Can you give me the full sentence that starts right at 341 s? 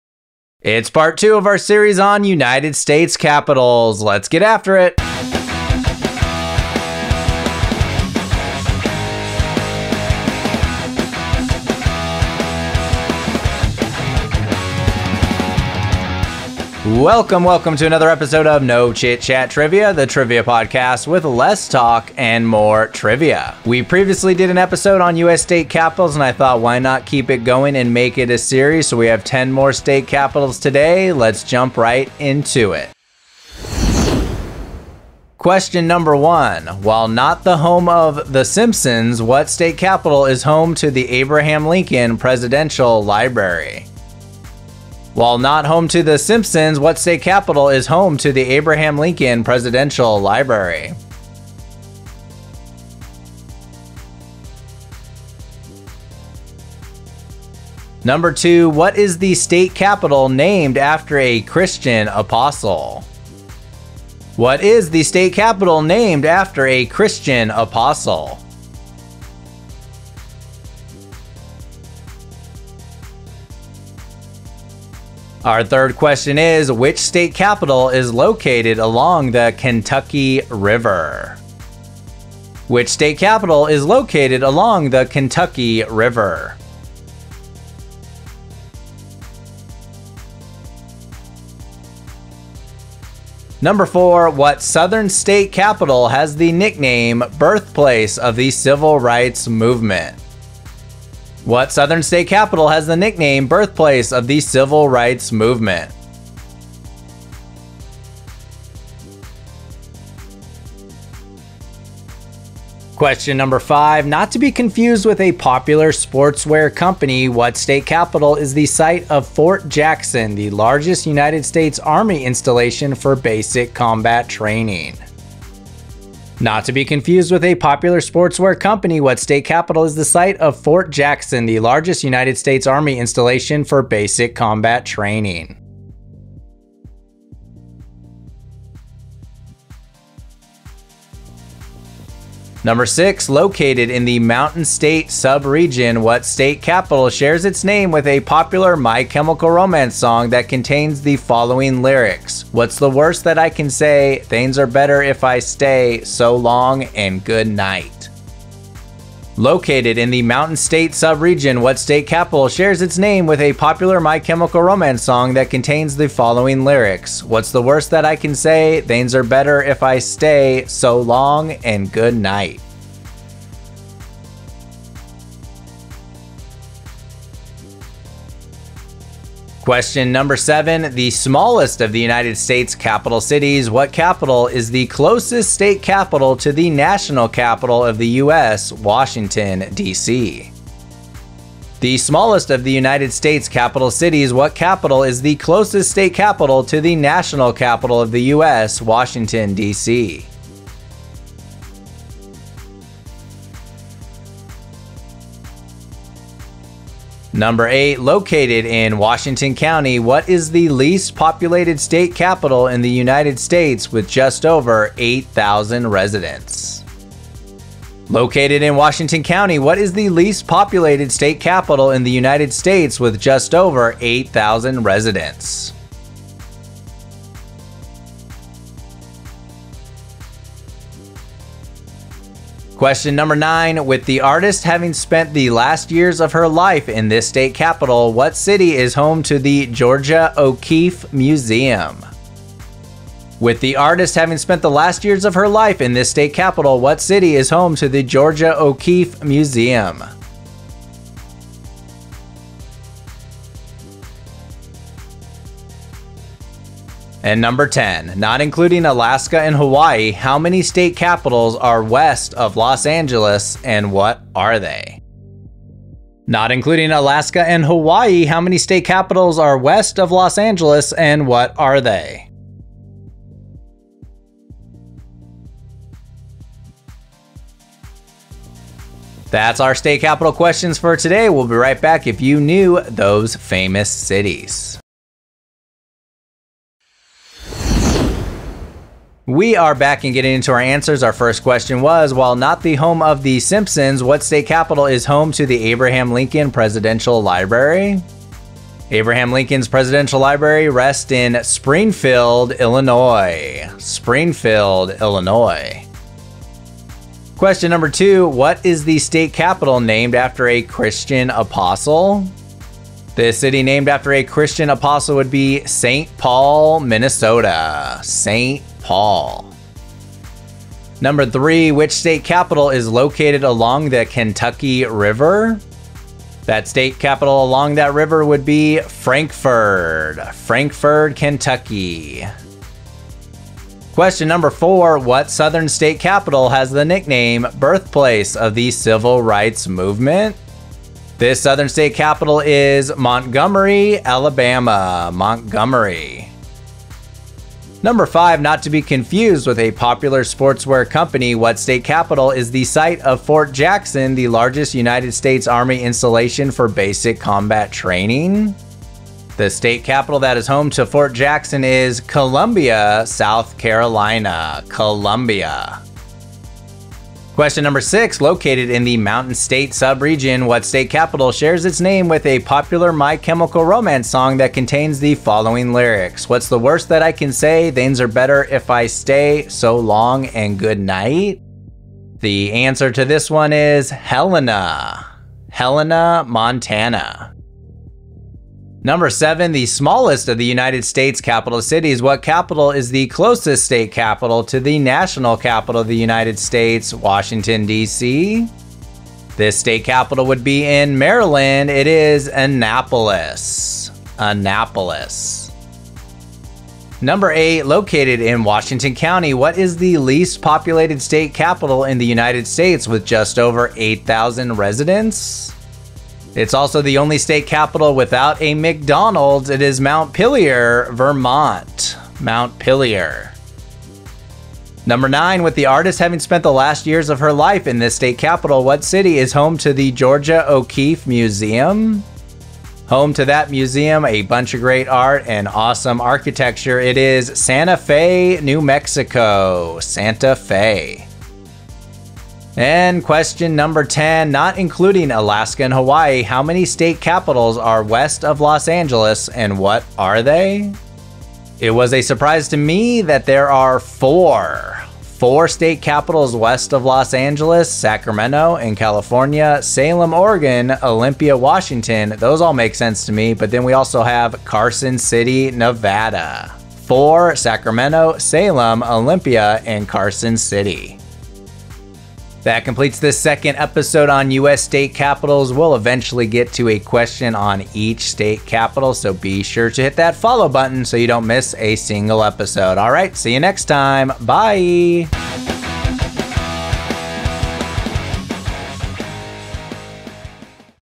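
This southern state capital is Montgomery, Alabama.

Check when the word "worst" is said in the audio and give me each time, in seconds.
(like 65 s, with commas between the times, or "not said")
152 s, 167 s, 376 s.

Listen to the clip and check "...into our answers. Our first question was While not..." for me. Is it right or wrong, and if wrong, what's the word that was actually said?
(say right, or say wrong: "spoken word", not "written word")
right.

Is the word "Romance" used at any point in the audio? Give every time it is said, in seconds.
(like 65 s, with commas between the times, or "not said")
149 s, 164 s, 373 s.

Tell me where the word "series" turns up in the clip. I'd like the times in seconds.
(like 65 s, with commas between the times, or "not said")
1 s, 28 s.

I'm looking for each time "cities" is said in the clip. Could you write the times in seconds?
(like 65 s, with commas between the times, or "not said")
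183 s, 193 s, 283 s, 391 s.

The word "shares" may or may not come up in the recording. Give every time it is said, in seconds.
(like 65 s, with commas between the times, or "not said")
147 s, 162 s, 371 s.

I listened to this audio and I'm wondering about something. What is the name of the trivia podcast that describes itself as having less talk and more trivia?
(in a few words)
No Chit Chat Trivia.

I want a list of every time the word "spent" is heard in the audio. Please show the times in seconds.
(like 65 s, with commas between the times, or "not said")
234 s, 244 s, 426 s.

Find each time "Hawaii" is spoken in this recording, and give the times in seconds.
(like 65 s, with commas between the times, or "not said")
259 s, 267 s, 445 s.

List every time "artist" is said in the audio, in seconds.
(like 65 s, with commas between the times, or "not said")
234 s, 243 s, 425 s.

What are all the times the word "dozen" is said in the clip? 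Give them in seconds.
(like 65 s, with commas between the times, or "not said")
not said.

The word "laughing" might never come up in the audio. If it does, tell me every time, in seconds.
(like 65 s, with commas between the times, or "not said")
not said.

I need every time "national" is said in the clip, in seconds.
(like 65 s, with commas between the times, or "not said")
186 s, 196 s, 394 s.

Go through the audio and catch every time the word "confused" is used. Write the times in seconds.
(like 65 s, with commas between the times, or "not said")
114 s, 126 s, 348 s.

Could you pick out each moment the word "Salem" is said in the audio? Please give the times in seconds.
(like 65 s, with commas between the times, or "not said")
459 s, 468 s.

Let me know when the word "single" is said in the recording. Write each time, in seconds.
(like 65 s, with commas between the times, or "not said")
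481 s.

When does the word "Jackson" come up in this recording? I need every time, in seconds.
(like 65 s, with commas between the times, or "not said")
119 s, 130 s, 353 s, 361 s.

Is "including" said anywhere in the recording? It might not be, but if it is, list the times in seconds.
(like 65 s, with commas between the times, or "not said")
258 s, 266 s, 444 s.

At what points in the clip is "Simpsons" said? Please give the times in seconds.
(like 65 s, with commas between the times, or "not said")
38 s, 46 s, 293 s.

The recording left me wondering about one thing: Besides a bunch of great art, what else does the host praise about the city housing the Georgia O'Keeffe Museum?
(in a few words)
Awesome architecture.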